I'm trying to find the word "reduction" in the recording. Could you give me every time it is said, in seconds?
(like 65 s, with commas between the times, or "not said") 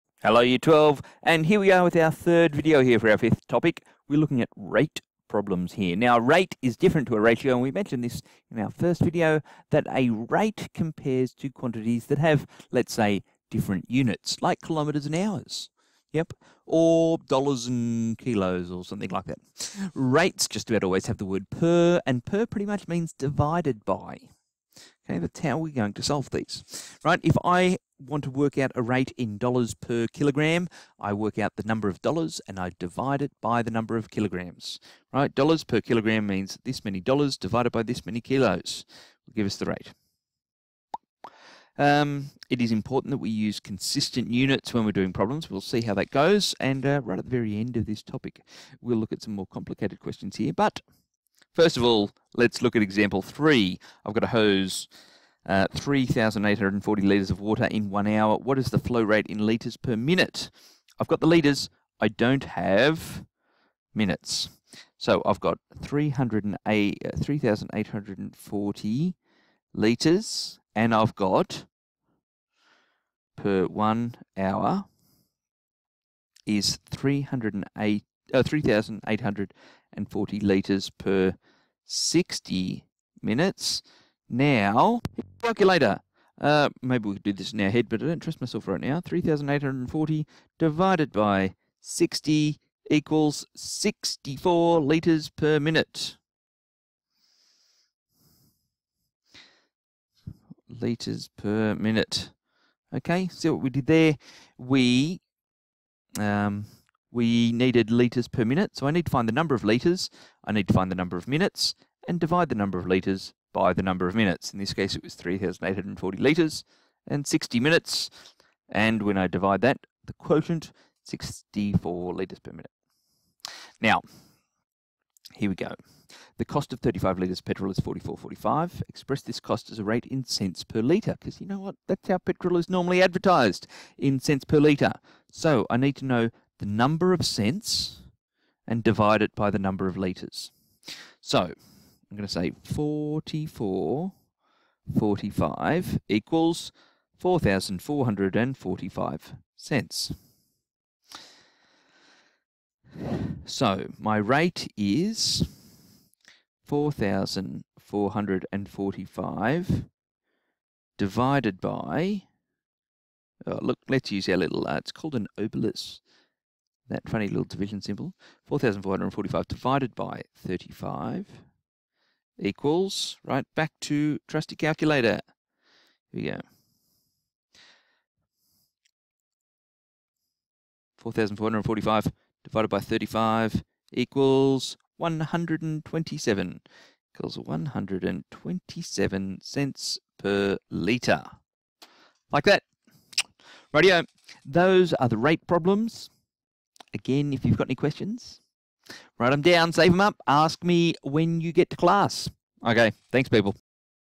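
not said.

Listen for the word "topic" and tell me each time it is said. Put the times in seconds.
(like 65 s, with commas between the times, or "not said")
3 s, 48 s.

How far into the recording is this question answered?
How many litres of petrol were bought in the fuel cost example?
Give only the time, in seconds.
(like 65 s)
126 s.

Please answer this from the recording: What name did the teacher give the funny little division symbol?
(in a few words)
obelisk.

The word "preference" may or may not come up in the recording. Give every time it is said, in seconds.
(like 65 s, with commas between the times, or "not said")
not said.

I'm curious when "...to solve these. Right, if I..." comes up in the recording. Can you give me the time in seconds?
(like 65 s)
25 s.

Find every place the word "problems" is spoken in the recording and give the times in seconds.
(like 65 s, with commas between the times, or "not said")
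5 s, 45 s, 195 s.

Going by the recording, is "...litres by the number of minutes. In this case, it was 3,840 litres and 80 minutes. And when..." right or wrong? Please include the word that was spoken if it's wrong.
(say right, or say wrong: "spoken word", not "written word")
wrong: "60", not "80".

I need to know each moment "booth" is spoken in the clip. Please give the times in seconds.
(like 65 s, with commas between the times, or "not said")
not said.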